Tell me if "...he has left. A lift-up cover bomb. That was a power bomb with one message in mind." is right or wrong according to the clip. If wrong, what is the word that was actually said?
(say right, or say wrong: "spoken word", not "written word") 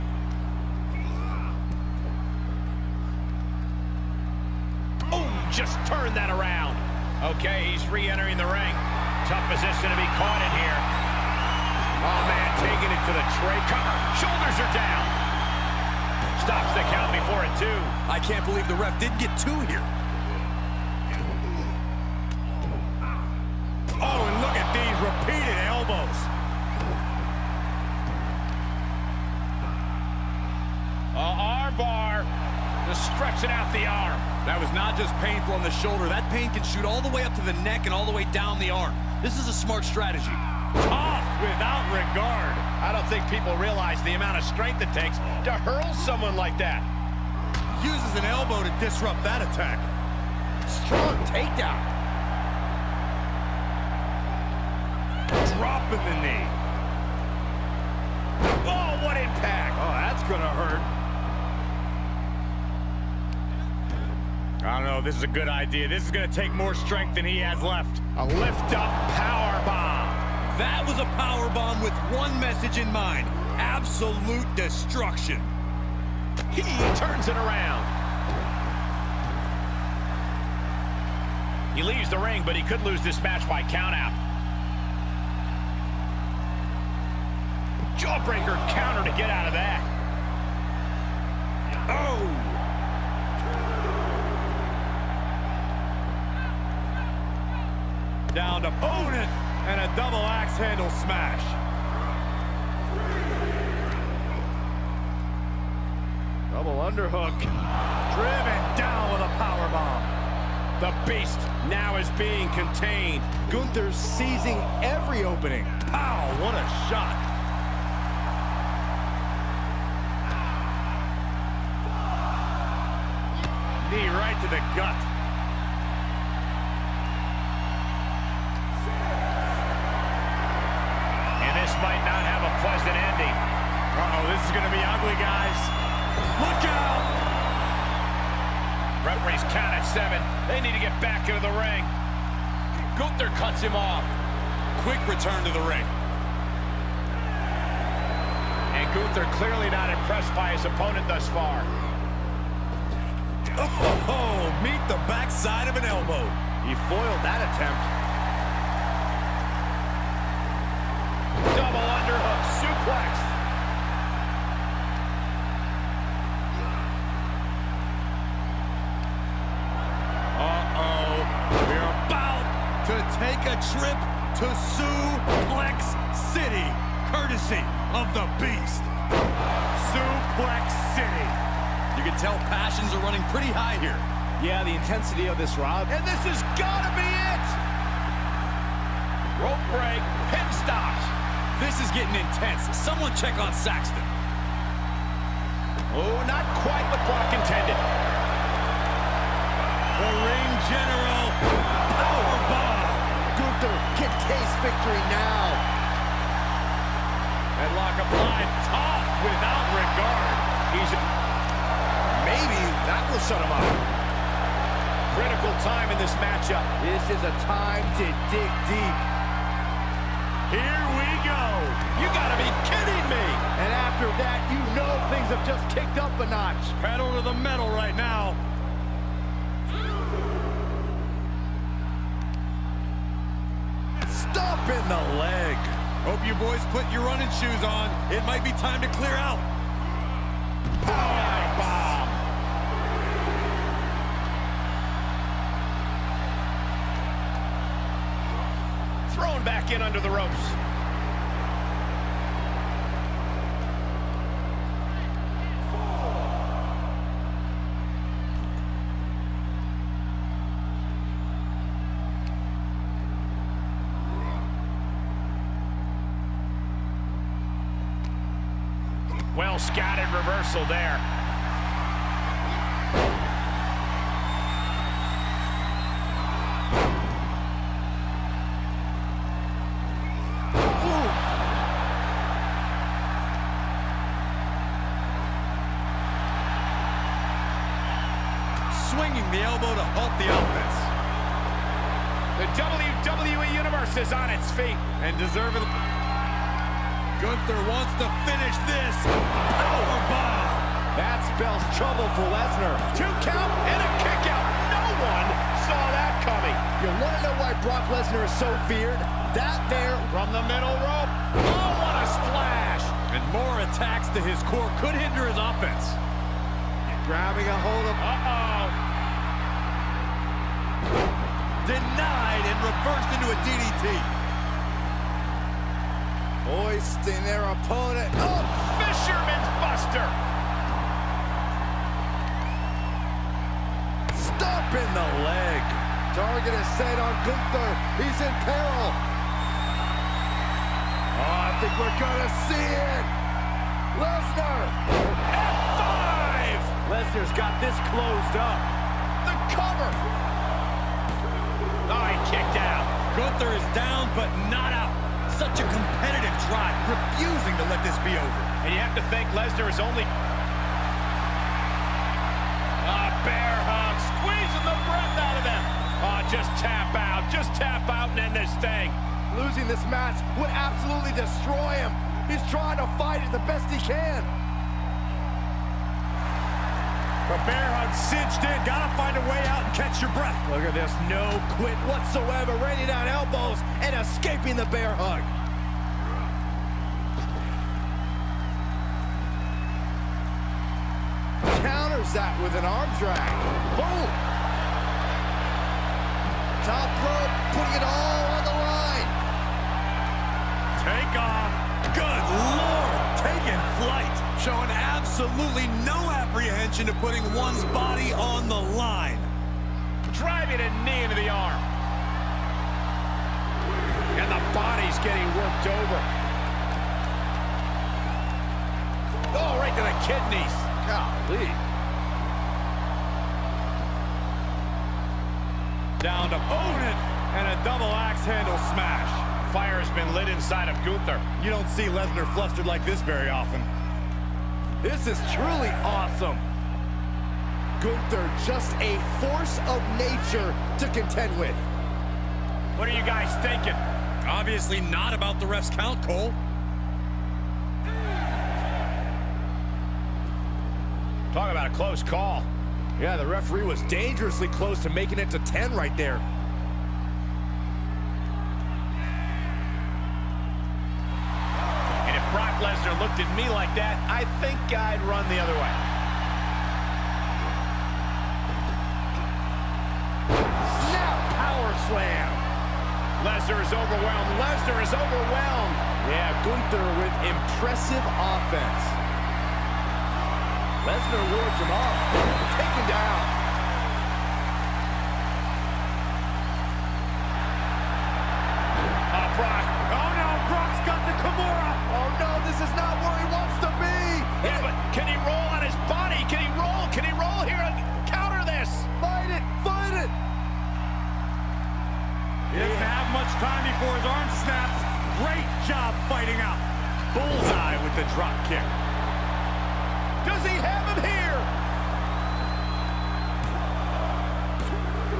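wrong: "power", not "cover".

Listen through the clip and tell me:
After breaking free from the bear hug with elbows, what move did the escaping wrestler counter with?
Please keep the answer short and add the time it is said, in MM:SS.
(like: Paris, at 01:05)
Arm drag, at 06:32.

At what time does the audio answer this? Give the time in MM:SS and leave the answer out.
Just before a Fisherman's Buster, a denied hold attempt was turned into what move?
05:22.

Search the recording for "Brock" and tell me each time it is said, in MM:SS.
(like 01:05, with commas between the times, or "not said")
03:17, 05:07.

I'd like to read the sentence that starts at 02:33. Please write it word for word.
Oh, meet the backside of an elbow.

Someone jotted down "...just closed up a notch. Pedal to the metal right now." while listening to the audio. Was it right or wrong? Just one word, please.
wrong.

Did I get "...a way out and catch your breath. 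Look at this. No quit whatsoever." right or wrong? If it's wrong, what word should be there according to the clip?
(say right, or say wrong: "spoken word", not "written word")
right.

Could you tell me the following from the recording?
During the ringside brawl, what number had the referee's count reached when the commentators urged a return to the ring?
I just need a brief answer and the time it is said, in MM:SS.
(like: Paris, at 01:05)
7, at 02:19.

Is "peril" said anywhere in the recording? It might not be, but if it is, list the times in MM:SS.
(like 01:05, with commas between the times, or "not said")
05:38.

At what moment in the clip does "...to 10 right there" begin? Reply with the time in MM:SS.
07:35.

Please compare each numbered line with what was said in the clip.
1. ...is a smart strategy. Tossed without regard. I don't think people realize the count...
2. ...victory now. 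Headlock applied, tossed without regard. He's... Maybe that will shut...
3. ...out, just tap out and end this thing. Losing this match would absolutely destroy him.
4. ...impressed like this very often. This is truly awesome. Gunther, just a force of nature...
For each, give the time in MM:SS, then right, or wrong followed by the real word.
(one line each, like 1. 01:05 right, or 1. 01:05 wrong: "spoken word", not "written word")
1. 00:39 wrong: "amount", not "count"
2. 03:24 right
3. 06:06 right
4. 07:12 wrong: "flustered", not "impressed".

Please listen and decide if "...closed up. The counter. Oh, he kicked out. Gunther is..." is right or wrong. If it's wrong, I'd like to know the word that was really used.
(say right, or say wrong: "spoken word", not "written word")
wrong: "cover", not "counter".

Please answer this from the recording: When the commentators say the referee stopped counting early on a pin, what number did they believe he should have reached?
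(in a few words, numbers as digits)
2.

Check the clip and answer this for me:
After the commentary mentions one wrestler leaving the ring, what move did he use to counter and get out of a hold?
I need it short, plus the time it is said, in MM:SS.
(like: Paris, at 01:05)
Jawbreaker, at 01:27.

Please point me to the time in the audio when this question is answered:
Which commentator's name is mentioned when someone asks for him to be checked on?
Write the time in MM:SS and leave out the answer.
03:12.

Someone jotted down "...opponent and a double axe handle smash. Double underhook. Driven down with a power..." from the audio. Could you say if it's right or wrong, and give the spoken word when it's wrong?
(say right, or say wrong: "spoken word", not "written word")
right.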